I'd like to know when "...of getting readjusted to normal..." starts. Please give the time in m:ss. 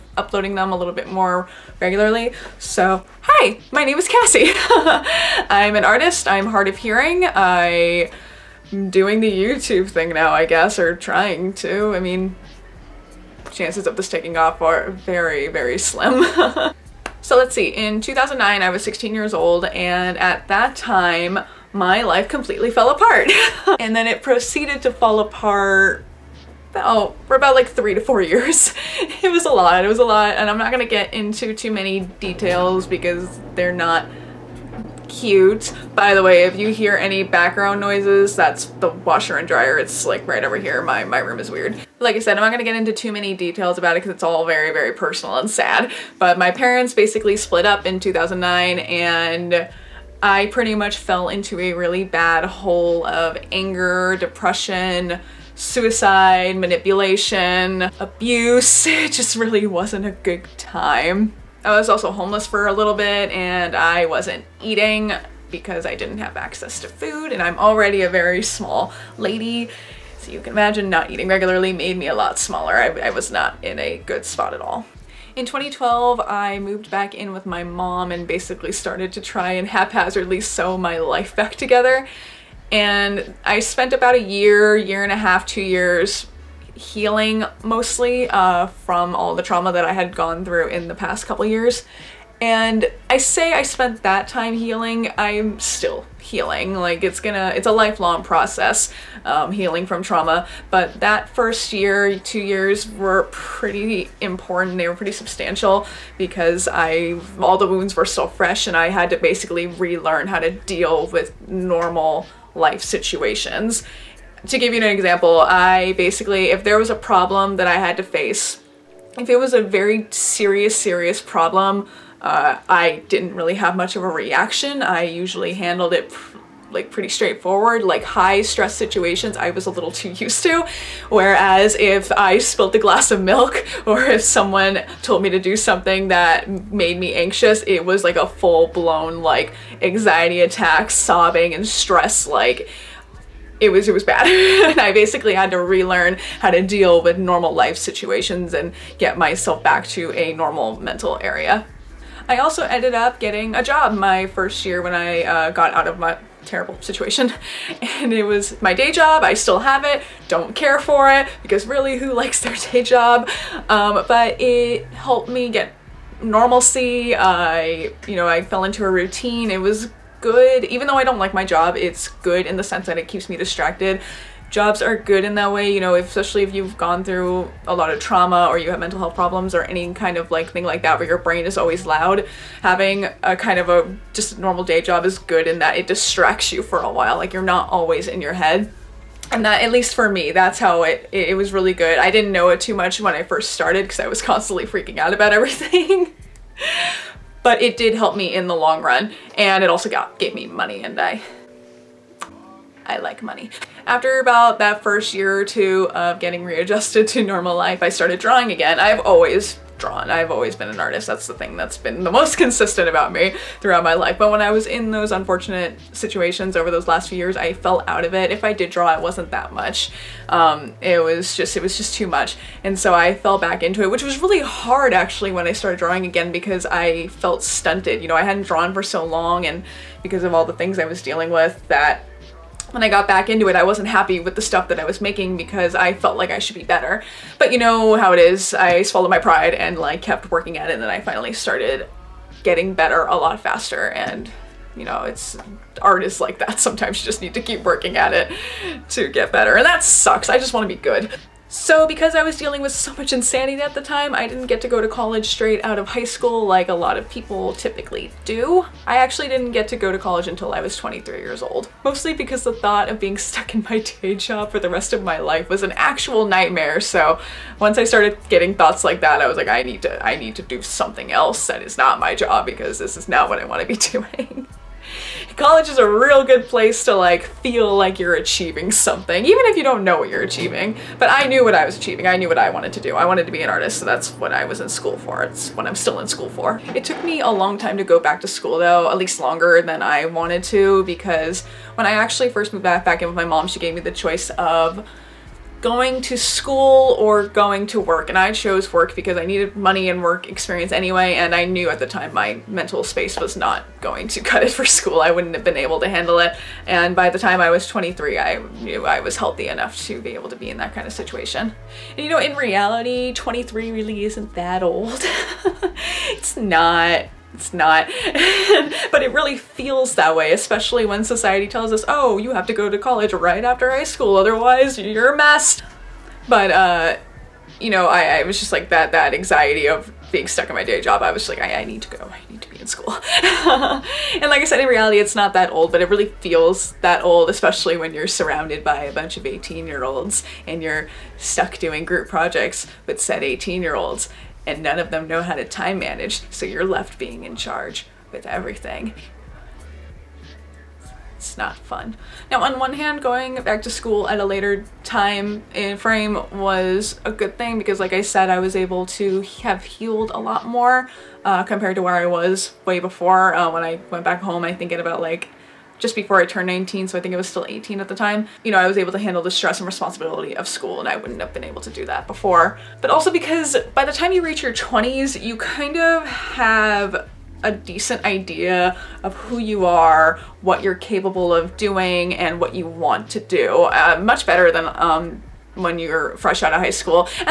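3:25.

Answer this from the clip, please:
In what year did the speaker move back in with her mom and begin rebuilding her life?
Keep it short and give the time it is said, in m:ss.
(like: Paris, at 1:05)
2012, at 1:15.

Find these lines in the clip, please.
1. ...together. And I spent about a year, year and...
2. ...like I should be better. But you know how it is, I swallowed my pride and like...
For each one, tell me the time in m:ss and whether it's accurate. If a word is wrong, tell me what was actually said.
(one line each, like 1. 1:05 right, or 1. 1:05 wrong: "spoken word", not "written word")
1. 1:21 right
2. 3:56 right.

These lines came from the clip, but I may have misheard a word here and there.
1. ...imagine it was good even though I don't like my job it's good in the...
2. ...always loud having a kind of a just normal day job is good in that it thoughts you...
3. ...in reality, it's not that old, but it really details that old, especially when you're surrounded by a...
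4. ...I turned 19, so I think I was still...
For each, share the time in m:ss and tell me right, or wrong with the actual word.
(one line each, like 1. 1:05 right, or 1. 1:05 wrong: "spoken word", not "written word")
1. 2:48 wrong: "routine", not "imagine"
2. 3:01 wrong: "distracts", not "thoughts"
3. 5:34 wrong: "feels", not "details"
4. 6:06 right.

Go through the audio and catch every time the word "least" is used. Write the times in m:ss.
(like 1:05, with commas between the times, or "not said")
3:09, 4:48.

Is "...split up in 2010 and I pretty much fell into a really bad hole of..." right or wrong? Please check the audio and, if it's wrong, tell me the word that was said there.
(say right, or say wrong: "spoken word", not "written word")
wrong: "2009", not "2010".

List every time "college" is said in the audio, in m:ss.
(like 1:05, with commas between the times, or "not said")
4:14, 4:19, 4:35, 5:22.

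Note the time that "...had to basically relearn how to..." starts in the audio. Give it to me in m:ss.
1:48.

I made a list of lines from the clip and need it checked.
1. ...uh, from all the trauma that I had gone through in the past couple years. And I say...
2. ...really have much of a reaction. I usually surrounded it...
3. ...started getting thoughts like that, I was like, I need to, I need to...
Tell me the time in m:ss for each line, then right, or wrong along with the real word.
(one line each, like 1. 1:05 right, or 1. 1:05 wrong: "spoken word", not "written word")
1. 1:28 right
2. 2:03 wrong: "handled", not "surrounded"
3. 4:27 right.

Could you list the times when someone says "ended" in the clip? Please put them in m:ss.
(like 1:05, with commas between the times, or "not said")
2:32.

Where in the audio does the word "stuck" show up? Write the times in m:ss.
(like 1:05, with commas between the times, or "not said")
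4:23, 5:30, 5:41.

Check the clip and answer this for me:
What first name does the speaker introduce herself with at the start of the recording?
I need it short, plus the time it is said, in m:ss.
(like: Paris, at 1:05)
Cassie, at 0:04.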